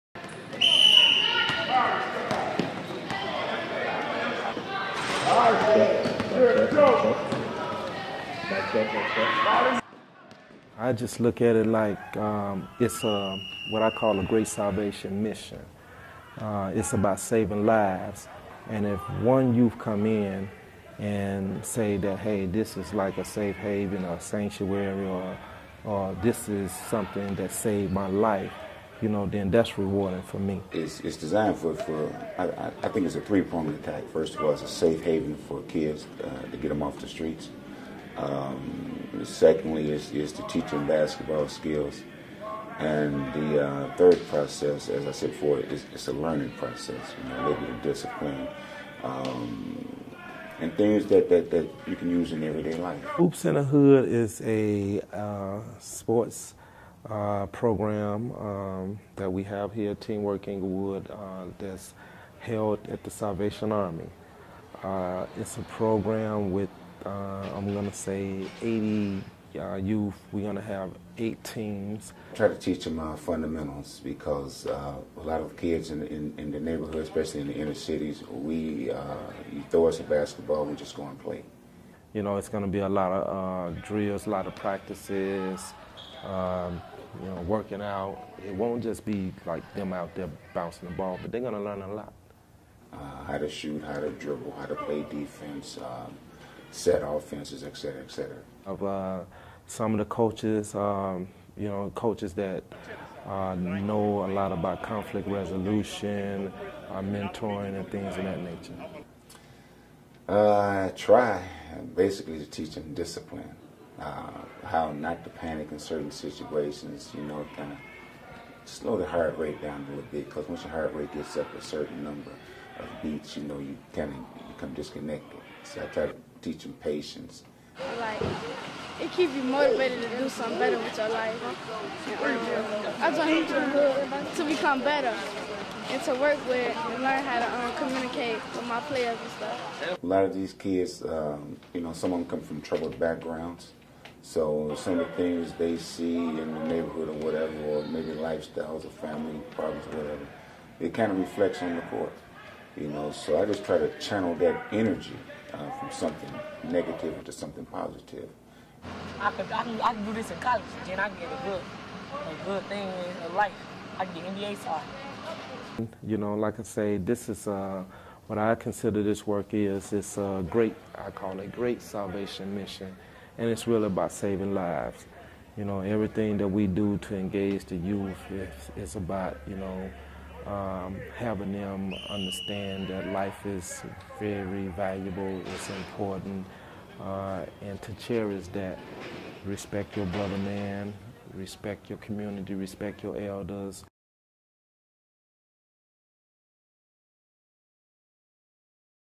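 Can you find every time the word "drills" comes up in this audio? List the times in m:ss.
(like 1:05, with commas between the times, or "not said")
1:23.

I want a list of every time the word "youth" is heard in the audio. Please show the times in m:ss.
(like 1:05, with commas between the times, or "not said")
0:19, 1:09, 2:57.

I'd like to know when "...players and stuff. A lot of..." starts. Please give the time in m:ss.
2:18.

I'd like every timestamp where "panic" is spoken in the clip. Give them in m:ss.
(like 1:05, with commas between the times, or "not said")
1:55.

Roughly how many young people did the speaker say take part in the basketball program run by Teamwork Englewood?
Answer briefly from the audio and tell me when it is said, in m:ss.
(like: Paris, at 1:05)
80, at 1:08.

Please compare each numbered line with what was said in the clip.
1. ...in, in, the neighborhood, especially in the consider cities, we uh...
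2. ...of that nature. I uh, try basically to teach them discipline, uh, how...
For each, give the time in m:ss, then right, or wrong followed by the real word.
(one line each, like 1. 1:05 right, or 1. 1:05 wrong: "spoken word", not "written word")
1. 1:16 wrong: "inner", not "consider"
2. 1:48 right.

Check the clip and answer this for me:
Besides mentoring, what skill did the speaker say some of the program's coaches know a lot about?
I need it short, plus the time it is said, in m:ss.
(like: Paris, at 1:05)
Conflict resolution, at 1:44.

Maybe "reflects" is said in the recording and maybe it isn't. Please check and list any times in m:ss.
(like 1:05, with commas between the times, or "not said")
2:31.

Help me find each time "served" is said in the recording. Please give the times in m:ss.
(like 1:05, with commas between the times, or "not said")
not said.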